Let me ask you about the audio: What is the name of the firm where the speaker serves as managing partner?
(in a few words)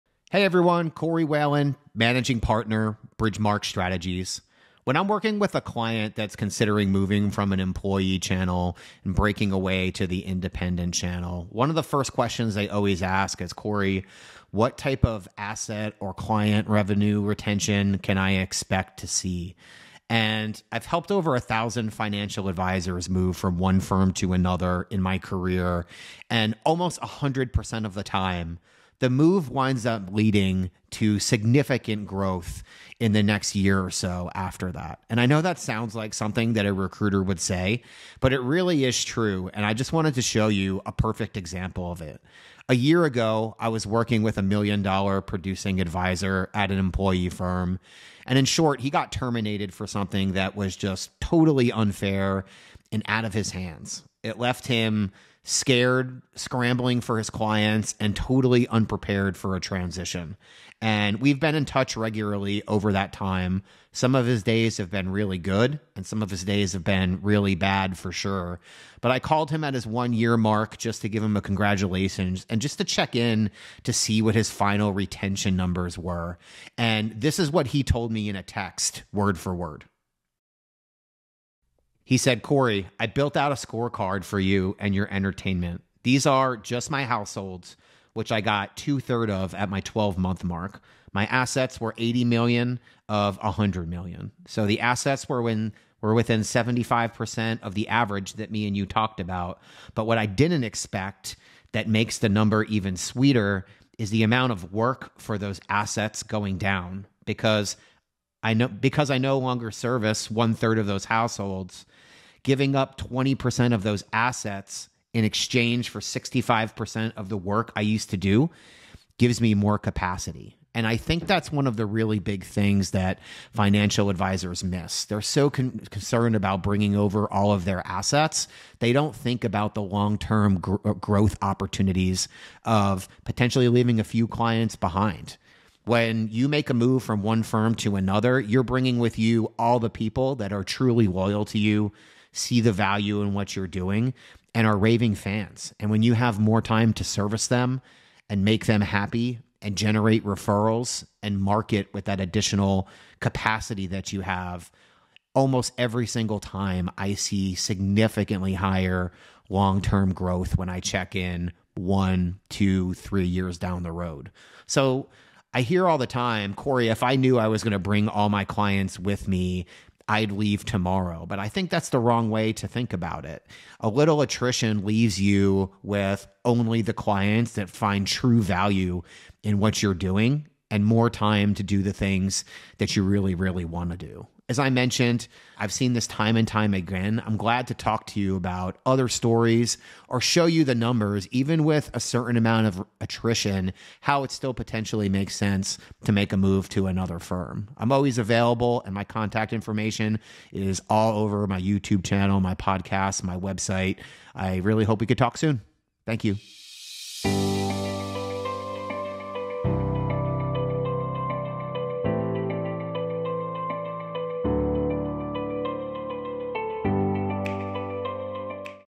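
Bridgemark Strategies.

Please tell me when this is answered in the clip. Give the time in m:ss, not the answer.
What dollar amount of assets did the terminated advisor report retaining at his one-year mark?
1:31.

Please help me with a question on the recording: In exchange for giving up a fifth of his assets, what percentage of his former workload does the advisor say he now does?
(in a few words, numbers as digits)
65%.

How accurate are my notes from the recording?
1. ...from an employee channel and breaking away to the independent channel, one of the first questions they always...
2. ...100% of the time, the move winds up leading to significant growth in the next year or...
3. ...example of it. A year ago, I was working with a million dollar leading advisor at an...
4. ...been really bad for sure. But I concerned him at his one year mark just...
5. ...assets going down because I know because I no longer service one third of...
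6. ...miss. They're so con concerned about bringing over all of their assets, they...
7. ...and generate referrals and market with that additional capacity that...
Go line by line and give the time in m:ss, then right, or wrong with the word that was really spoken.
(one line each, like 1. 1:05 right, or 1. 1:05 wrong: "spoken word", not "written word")
1. 0:07 right
2. 0:27 right
3. 0:41 wrong: "producing", not "leading"
4. 1:06 wrong: "called", not "concerned"
5. 1:45 right
6. 2:04 right
7. 2:29 right.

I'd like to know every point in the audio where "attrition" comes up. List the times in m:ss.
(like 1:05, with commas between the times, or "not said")
2:54, 3:12.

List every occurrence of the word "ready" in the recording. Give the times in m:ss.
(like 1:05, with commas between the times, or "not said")
not said.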